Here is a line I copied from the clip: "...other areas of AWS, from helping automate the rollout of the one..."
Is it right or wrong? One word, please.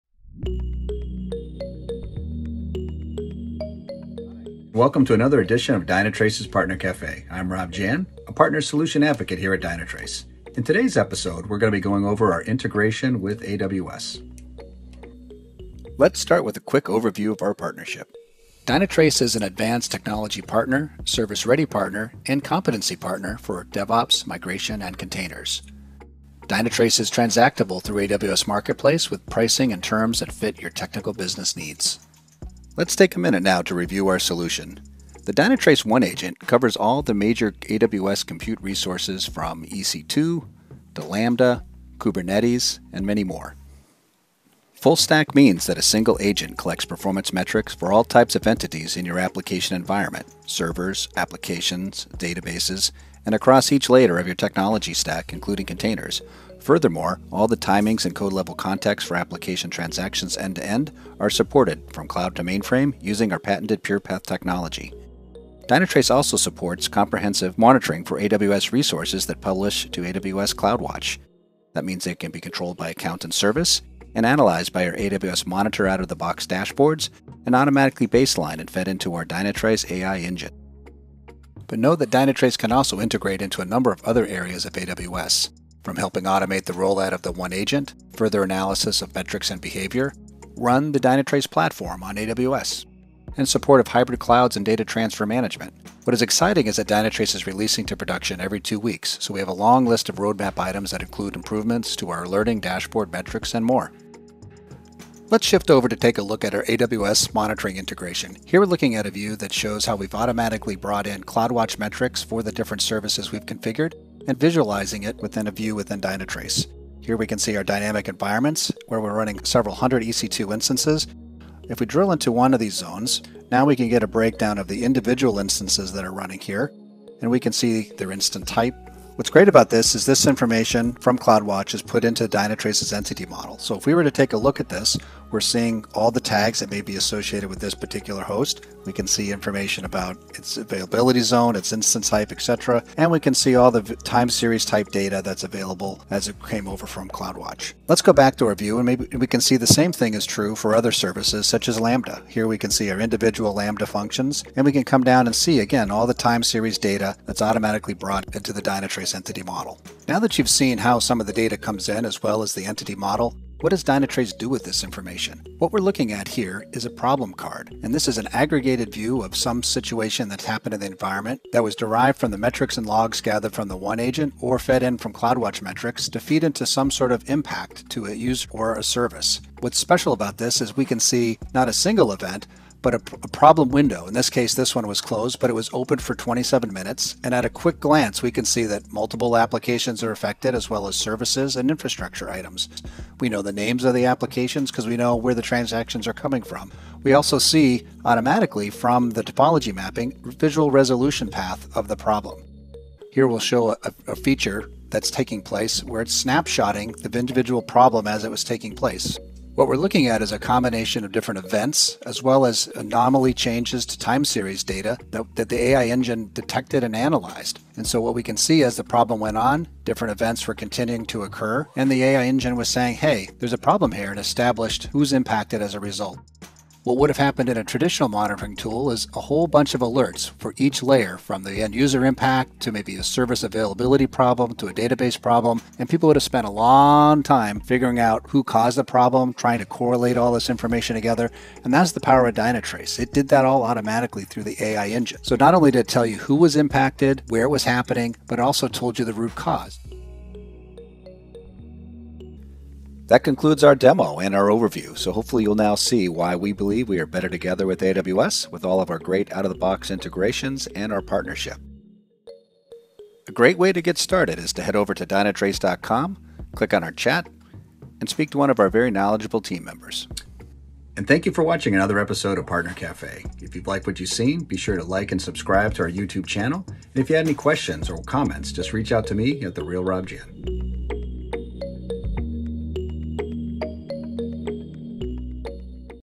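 right.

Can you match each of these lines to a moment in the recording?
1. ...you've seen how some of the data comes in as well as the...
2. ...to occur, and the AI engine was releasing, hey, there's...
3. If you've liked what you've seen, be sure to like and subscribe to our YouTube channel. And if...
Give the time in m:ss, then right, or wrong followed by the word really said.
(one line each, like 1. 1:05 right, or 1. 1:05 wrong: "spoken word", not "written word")
1. 2:40 right
2. 3:41 wrong: "saying", not "releasing"
3. 4:33 right.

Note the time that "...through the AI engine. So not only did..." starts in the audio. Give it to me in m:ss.
4:04.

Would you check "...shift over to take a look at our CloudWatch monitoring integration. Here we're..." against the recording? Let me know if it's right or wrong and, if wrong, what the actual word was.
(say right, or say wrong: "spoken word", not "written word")
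wrong: "AWS", not "CloudWatch".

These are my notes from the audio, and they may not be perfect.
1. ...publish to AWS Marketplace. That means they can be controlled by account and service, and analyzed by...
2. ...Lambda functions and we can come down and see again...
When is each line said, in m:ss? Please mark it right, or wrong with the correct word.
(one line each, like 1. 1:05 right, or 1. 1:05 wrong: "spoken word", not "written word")
1. 1:09 wrong: "CloudWatch", not "Marketplace"
2. 2:33 right.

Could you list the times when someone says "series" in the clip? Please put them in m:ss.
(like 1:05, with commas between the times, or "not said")
2:24, 2:36, 3:34.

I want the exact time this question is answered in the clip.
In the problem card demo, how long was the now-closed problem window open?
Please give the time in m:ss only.
3:06.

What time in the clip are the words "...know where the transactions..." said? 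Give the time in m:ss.
3:14.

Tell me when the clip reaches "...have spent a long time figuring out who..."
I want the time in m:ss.
3:56.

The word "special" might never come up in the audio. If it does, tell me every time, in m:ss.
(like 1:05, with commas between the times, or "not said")
2:59.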